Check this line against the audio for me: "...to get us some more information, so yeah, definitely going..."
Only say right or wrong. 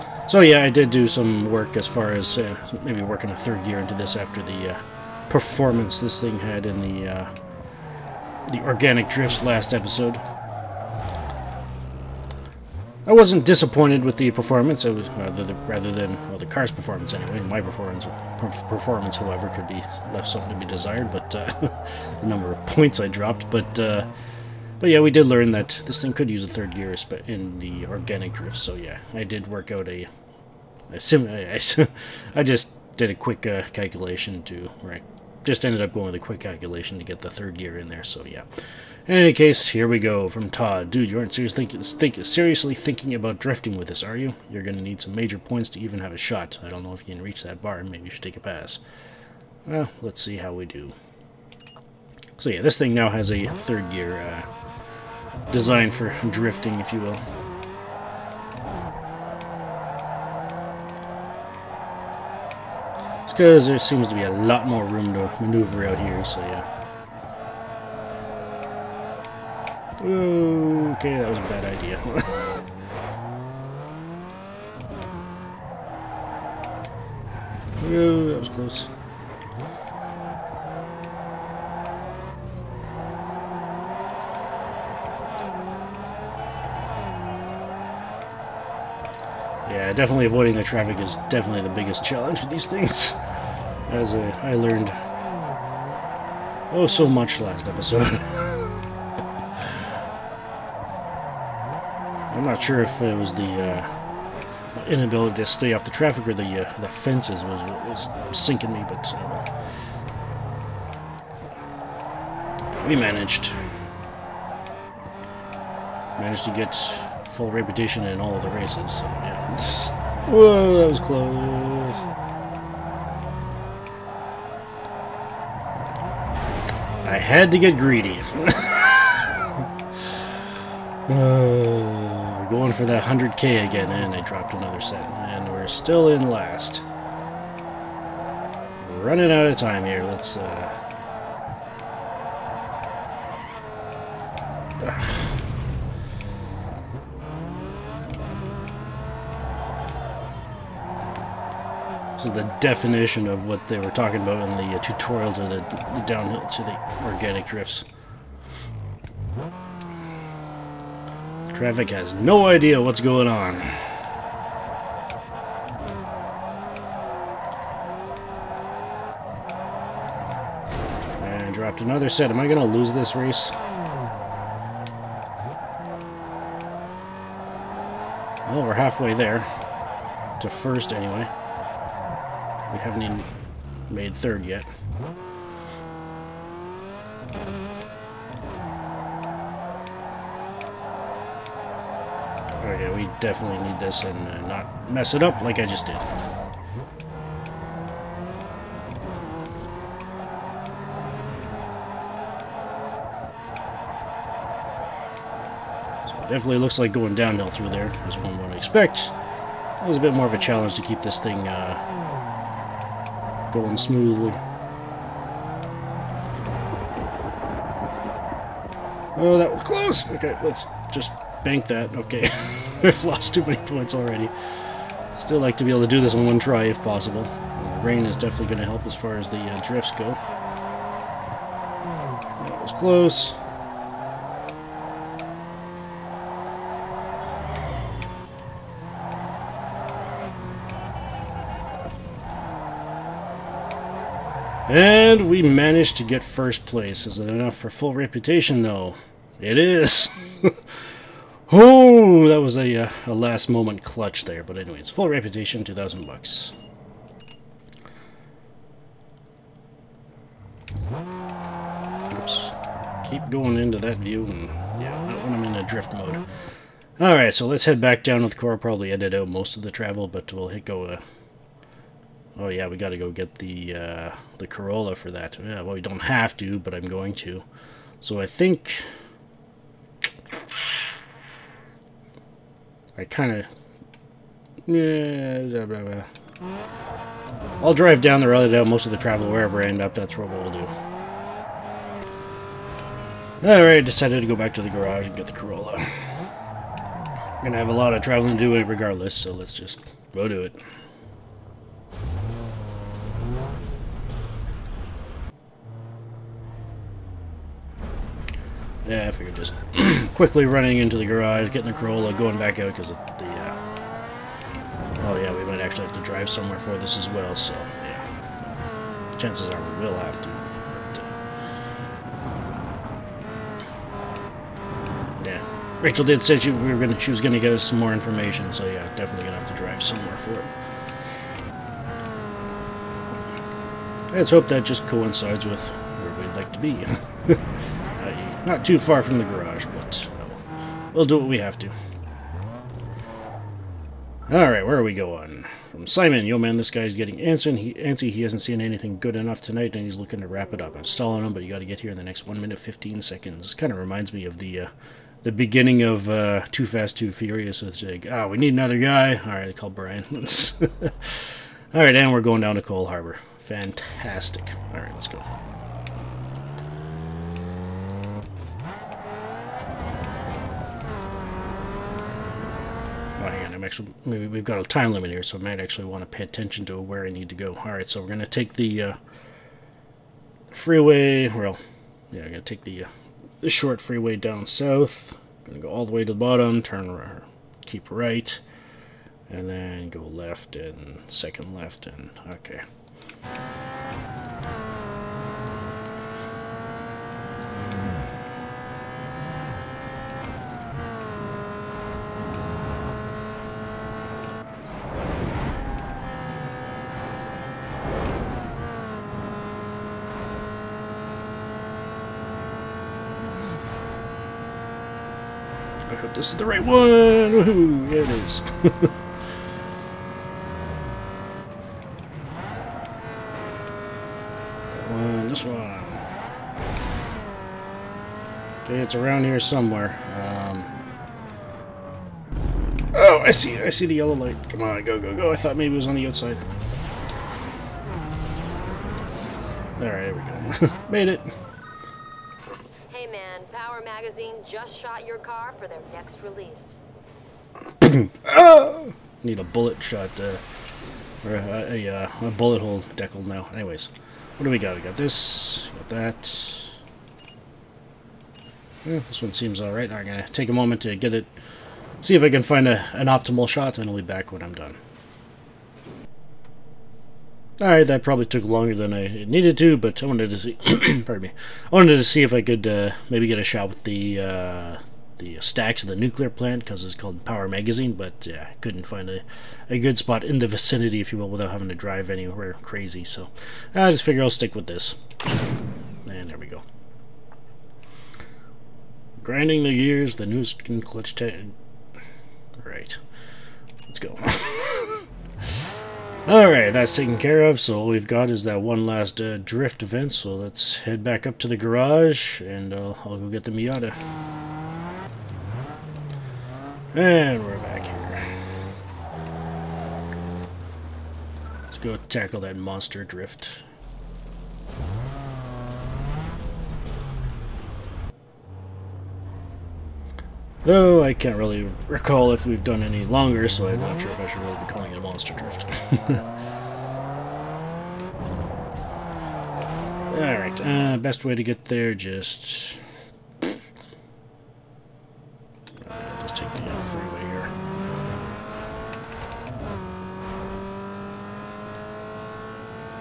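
right.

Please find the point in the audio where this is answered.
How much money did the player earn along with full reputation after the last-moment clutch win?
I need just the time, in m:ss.
4:15.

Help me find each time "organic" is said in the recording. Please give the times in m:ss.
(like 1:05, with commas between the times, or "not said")
0:08, 0:27, 2:37.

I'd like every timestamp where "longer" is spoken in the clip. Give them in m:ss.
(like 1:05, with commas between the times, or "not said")
7:48, 8:43.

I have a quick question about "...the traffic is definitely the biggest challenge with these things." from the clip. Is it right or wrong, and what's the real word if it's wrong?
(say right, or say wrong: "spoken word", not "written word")
right.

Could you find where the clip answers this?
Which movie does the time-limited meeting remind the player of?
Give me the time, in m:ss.
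5:56.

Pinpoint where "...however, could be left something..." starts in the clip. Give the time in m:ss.
0:19.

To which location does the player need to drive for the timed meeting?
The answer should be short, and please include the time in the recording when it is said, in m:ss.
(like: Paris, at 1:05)
Coal Harbor, at 6:02.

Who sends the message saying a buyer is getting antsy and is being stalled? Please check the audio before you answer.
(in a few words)
Simon.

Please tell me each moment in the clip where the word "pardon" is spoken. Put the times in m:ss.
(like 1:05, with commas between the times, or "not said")
7:50.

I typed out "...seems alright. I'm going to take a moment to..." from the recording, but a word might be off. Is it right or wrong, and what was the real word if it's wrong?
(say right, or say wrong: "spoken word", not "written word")
right.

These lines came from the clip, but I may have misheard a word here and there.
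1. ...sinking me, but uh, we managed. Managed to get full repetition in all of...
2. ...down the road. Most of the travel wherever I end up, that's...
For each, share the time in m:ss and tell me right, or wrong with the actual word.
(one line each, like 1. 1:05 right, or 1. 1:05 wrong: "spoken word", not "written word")
1. 1:48 right
2. 4:48 right.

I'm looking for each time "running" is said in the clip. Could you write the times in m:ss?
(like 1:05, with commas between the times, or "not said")
2:19, 5:10.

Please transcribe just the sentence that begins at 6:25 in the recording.
going to go all the way to the bottom, turn keep right, and then go left and second left, and okay.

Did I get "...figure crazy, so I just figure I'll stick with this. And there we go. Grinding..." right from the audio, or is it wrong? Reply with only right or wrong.
wrong.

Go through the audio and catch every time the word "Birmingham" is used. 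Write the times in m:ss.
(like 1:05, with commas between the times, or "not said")
not said.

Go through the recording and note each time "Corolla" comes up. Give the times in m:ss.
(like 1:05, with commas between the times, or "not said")
4:34, 4:55, 5:11.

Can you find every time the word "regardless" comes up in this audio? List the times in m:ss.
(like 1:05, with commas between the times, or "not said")
4:58.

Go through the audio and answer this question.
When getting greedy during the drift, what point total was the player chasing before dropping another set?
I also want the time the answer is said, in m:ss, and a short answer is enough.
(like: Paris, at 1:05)
100k, at 2:13.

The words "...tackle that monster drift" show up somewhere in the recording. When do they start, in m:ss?
8:31.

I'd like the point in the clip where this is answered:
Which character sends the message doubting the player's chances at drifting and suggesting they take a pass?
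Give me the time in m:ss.
0:40.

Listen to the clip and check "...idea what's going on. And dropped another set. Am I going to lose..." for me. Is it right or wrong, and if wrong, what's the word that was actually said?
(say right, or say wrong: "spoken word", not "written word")
right.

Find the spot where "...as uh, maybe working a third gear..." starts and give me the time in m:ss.
0:02.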